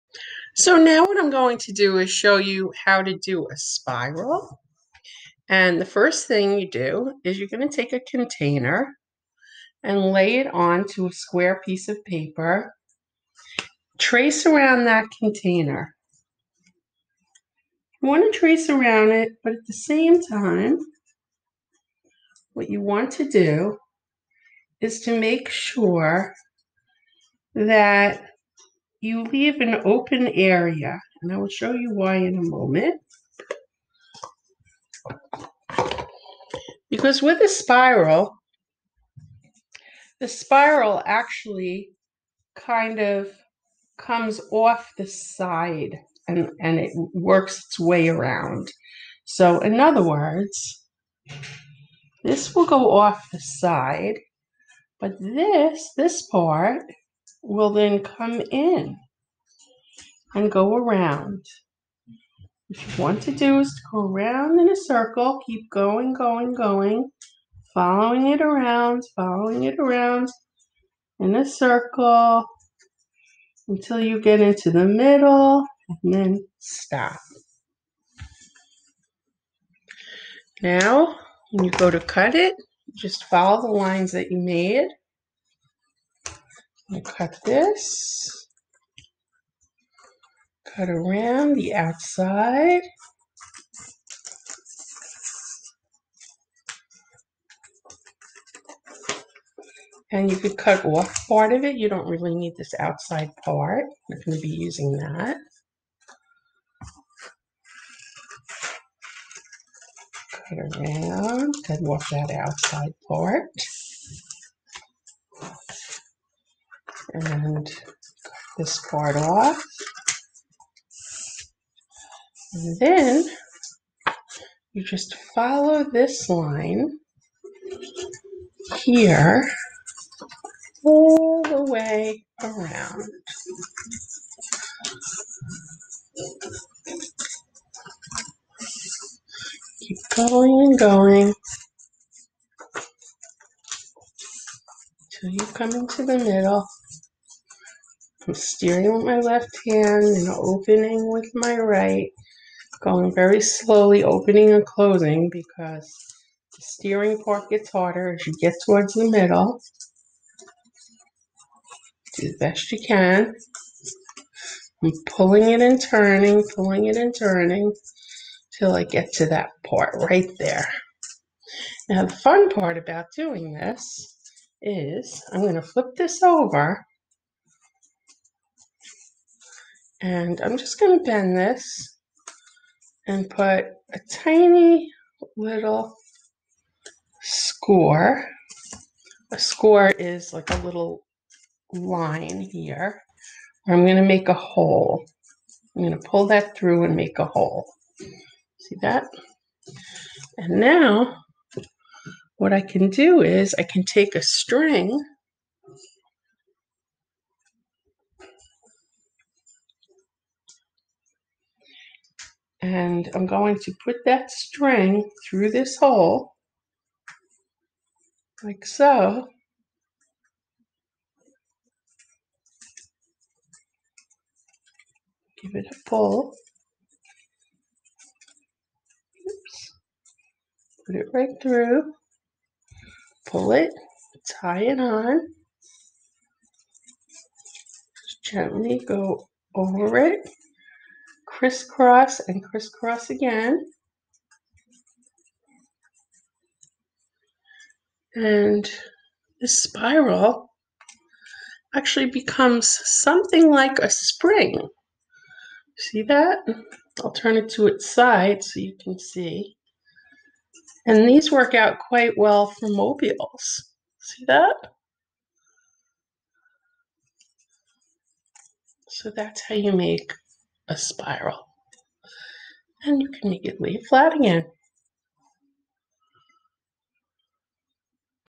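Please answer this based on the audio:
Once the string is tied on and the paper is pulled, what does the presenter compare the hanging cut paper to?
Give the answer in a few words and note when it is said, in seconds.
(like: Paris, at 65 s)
a spring, at 253 s.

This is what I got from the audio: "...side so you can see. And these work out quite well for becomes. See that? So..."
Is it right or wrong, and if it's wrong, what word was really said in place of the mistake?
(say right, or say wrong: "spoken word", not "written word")
wrong: "mobiles", not "becomes".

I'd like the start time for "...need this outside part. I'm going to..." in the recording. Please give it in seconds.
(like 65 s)
102 s.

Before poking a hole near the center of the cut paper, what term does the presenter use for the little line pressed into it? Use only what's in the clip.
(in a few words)
a score.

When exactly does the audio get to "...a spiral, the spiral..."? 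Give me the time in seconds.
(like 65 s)
37 s.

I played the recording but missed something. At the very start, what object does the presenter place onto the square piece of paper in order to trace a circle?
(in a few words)
a container.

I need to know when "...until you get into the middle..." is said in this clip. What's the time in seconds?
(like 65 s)
73 s.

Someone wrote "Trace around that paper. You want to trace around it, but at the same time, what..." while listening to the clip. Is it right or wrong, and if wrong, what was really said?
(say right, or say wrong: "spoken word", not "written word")
wrong: "container", not "paper".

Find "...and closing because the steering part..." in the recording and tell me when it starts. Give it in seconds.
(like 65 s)
154 s.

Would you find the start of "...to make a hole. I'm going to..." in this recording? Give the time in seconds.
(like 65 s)
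193 s.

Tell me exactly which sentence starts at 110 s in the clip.
Cut around, cut off that outside part and this part off.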